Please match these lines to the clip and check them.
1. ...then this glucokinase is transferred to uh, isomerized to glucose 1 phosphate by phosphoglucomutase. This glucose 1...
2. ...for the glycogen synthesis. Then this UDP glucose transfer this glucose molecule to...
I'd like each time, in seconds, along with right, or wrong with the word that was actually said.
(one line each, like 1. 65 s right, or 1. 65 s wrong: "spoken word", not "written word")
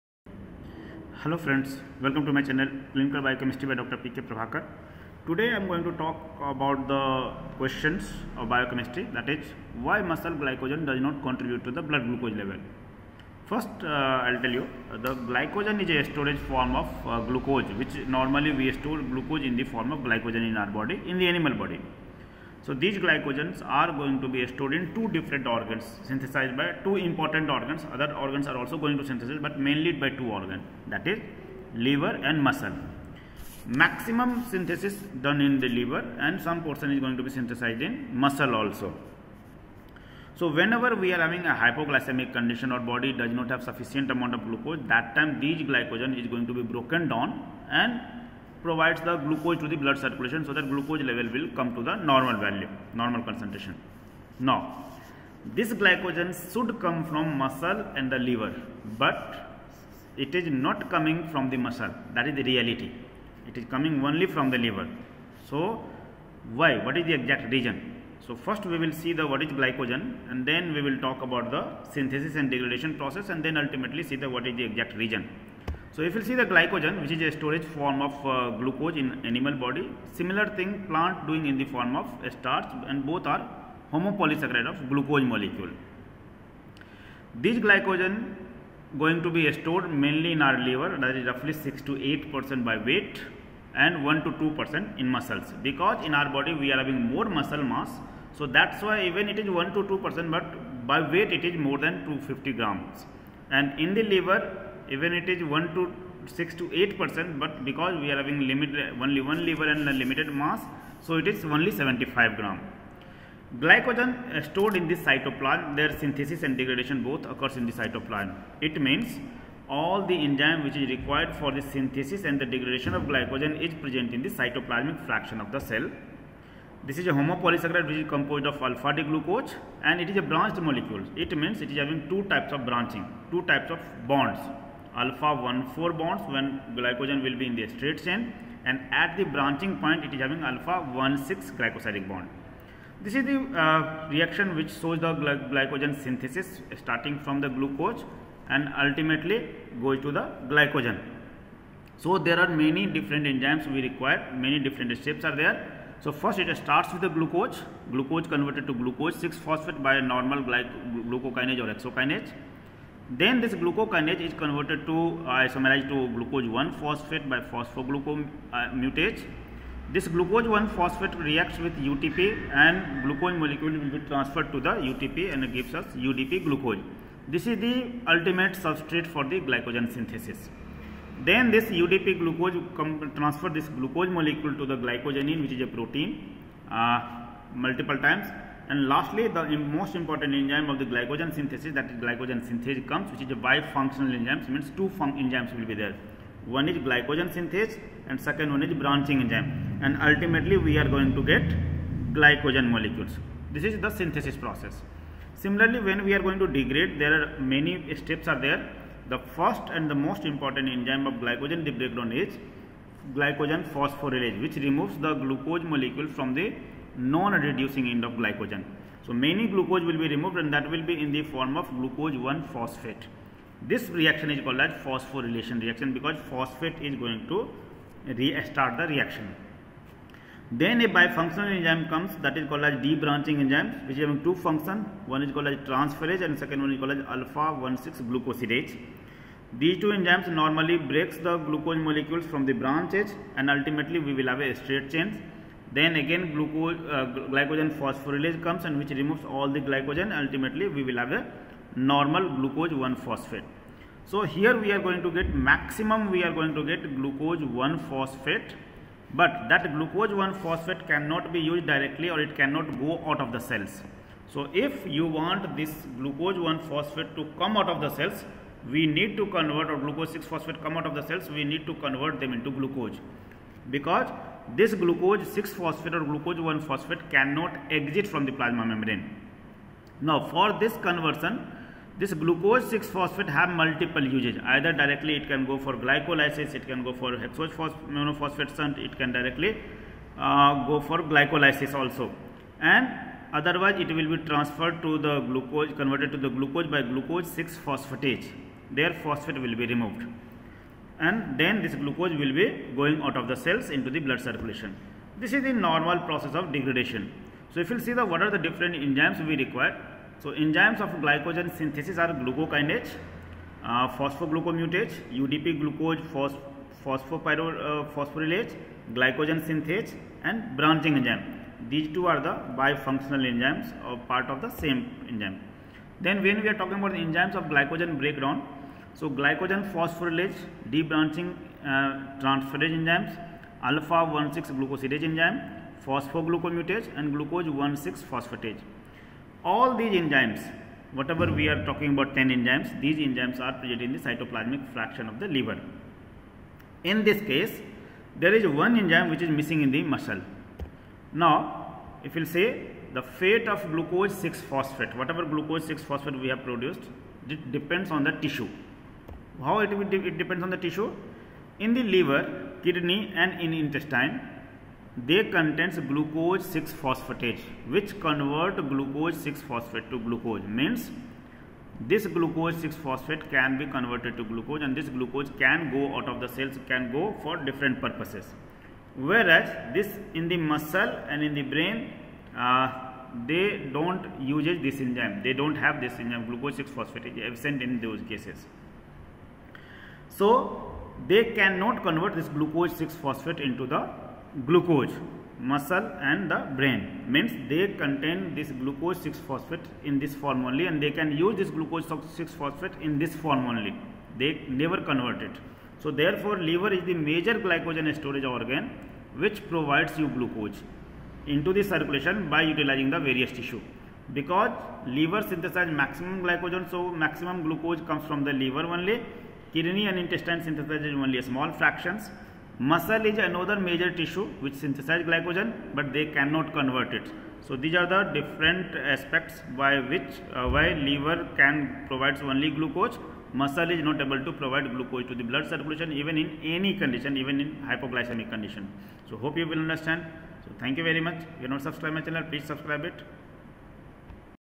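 1. 163 s wrong: "converted", not "transferred"
2. 179 s right.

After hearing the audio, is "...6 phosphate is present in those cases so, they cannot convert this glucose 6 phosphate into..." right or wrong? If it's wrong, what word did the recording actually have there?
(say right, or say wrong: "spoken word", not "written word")
wrong: "absent", not "present".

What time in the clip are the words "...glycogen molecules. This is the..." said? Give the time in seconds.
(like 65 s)
202 s.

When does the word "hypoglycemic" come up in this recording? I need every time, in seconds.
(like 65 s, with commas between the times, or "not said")
41 s, 437 s.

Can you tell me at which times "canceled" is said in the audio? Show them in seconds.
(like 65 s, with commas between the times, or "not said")
not said.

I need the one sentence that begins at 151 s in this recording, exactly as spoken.
So there are many different enzymes we require, many different steps are there.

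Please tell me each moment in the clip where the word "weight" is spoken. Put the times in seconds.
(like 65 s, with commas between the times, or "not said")
92 s, 101 s.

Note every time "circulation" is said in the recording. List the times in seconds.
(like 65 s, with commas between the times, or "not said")
49 s, 304 s, 411 s, 435 s.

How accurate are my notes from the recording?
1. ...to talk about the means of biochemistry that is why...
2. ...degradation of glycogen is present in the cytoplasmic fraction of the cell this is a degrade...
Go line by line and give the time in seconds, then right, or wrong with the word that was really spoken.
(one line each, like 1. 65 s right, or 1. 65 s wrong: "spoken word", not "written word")
1. 5 s wrong: "questions", not "means"
2. 122 s wrong: "homopolysaccharide", not "degrade".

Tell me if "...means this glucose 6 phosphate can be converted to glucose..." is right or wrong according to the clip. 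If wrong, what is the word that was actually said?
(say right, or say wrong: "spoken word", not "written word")
right.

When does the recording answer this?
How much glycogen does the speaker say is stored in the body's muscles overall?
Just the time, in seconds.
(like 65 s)
101 s.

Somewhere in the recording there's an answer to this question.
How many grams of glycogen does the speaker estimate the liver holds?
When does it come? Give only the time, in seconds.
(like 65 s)
111 s.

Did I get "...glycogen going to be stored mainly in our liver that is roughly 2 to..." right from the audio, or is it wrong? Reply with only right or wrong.
wrong.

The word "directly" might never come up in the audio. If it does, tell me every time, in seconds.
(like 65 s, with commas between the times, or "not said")
261 s, 284 s, 289 s.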